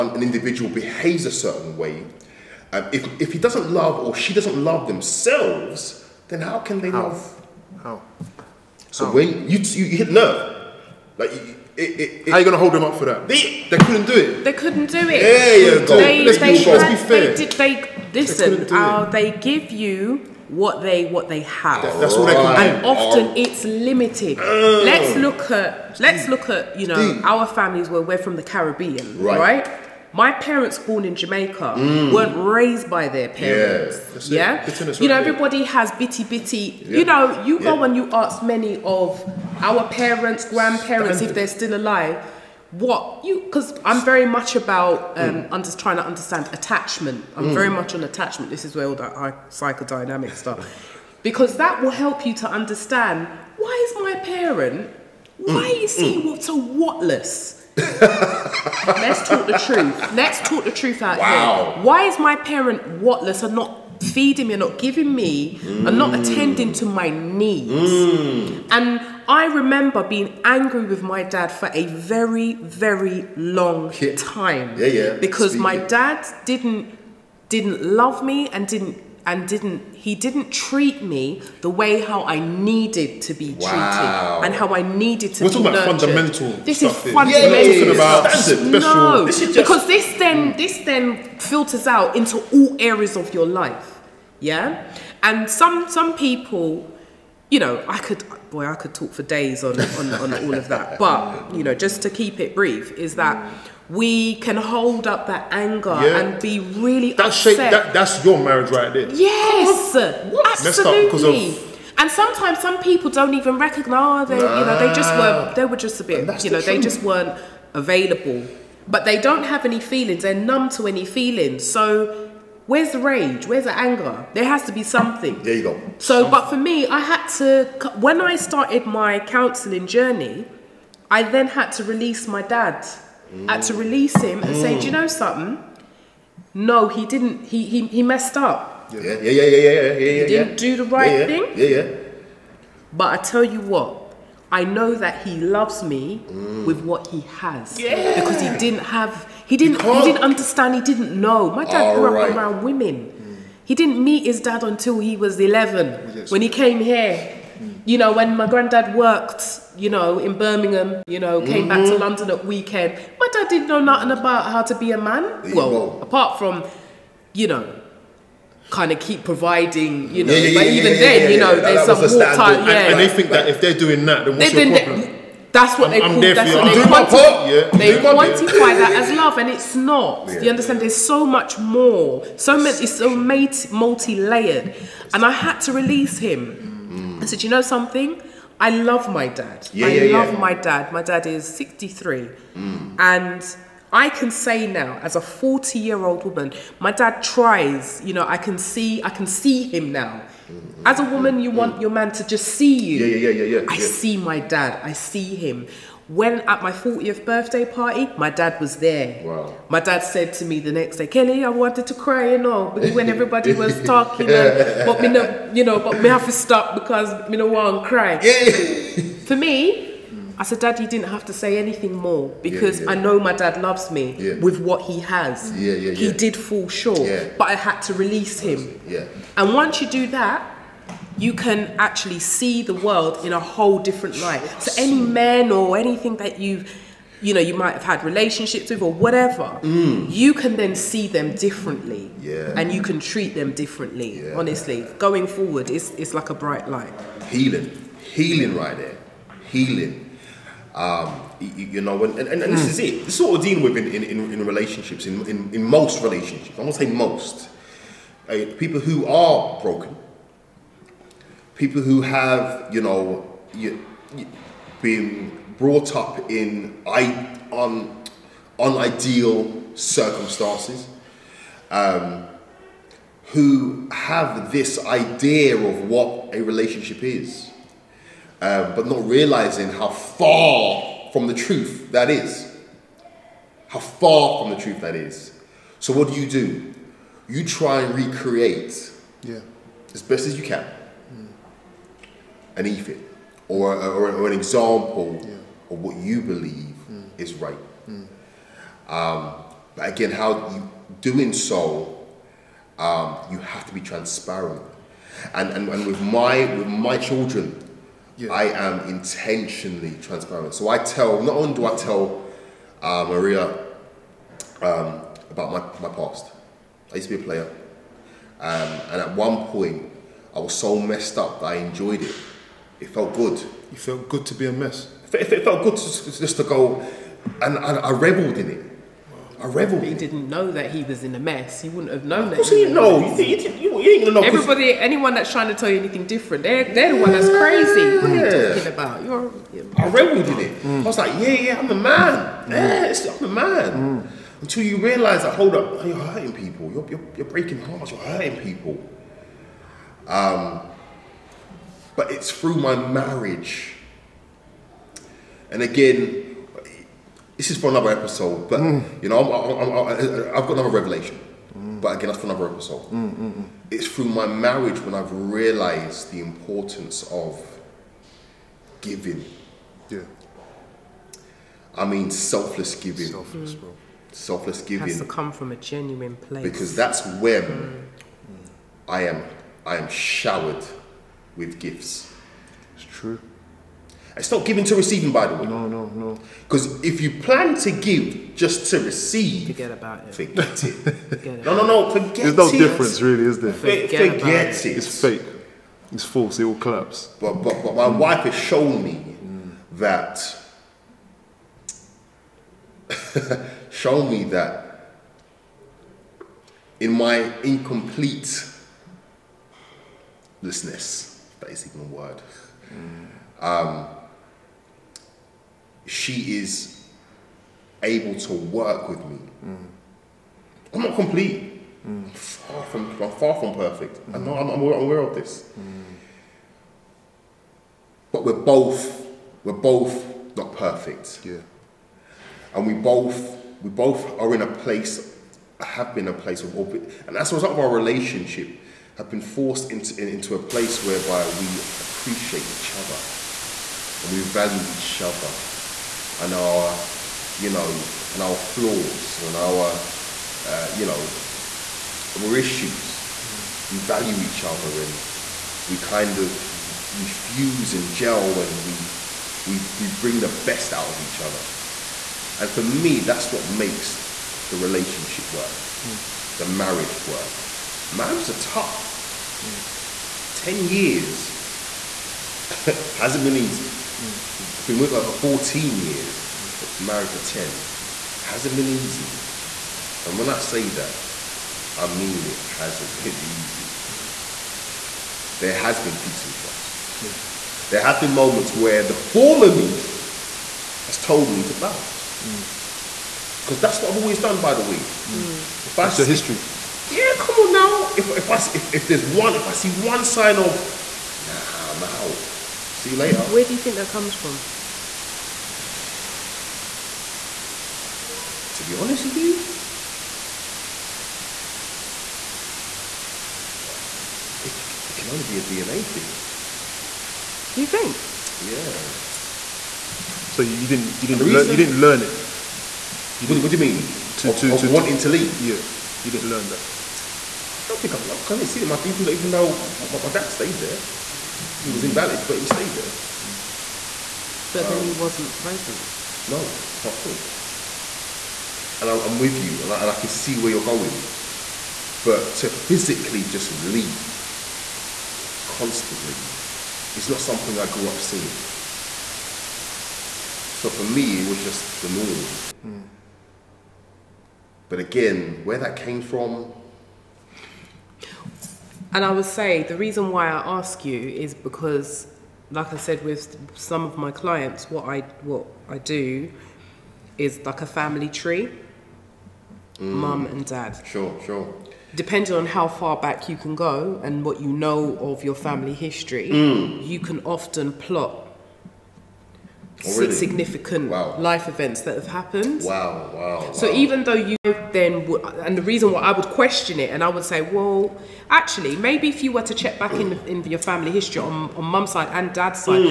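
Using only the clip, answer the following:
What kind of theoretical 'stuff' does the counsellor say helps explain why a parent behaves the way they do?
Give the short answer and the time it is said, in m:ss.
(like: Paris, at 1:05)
psychodynamic, at 0:49.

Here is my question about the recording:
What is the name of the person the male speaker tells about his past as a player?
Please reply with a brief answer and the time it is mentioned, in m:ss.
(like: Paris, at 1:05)
Maria, at 5:13.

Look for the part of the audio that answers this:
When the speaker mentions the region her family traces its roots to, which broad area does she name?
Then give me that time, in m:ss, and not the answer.
0:28.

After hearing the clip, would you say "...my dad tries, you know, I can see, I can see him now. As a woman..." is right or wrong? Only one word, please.
right.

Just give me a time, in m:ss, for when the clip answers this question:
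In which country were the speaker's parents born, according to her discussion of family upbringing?
0:31.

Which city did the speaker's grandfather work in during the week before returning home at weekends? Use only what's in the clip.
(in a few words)
Birmingham.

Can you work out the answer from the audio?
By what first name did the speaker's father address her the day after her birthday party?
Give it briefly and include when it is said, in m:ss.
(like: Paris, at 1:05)
Kelly, at 3:31.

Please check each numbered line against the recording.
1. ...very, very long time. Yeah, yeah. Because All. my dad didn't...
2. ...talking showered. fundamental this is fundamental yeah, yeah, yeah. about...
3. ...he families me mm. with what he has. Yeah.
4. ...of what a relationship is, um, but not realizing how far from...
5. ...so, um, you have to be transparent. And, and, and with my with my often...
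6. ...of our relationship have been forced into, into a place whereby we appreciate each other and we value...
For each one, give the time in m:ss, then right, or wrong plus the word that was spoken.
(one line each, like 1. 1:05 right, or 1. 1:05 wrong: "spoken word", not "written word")
1. 1:11 wrong: "Speaking", not "All"
2. 1:25 wrong: "nurtured", not "showered"
3. 2:25 wrong: "loves", not "families"
4. 4:35 right
5. 5:01 wrong: "children", not "often"
6. 7:17 right.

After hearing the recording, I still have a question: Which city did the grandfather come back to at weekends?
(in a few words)
London.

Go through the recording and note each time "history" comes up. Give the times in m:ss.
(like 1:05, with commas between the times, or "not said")
8:16, 9:35, 9:50.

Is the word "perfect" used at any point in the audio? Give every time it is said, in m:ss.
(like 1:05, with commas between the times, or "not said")
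7:03, 7:10.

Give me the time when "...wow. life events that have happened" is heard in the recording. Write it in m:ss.
9:40.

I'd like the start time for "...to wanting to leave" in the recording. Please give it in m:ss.
8:44.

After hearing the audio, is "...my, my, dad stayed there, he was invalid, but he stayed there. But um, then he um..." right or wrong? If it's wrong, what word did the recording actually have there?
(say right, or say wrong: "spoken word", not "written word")
right.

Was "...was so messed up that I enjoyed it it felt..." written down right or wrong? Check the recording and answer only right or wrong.
right.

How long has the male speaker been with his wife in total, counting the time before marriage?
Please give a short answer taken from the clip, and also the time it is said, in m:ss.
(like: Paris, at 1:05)
14 years, at 7:55.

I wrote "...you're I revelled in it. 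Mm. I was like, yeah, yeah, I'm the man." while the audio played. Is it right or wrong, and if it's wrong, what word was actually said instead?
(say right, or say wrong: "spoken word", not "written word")
right.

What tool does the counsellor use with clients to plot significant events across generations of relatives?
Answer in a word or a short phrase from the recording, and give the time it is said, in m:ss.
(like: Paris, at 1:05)
family tree, at 9:27.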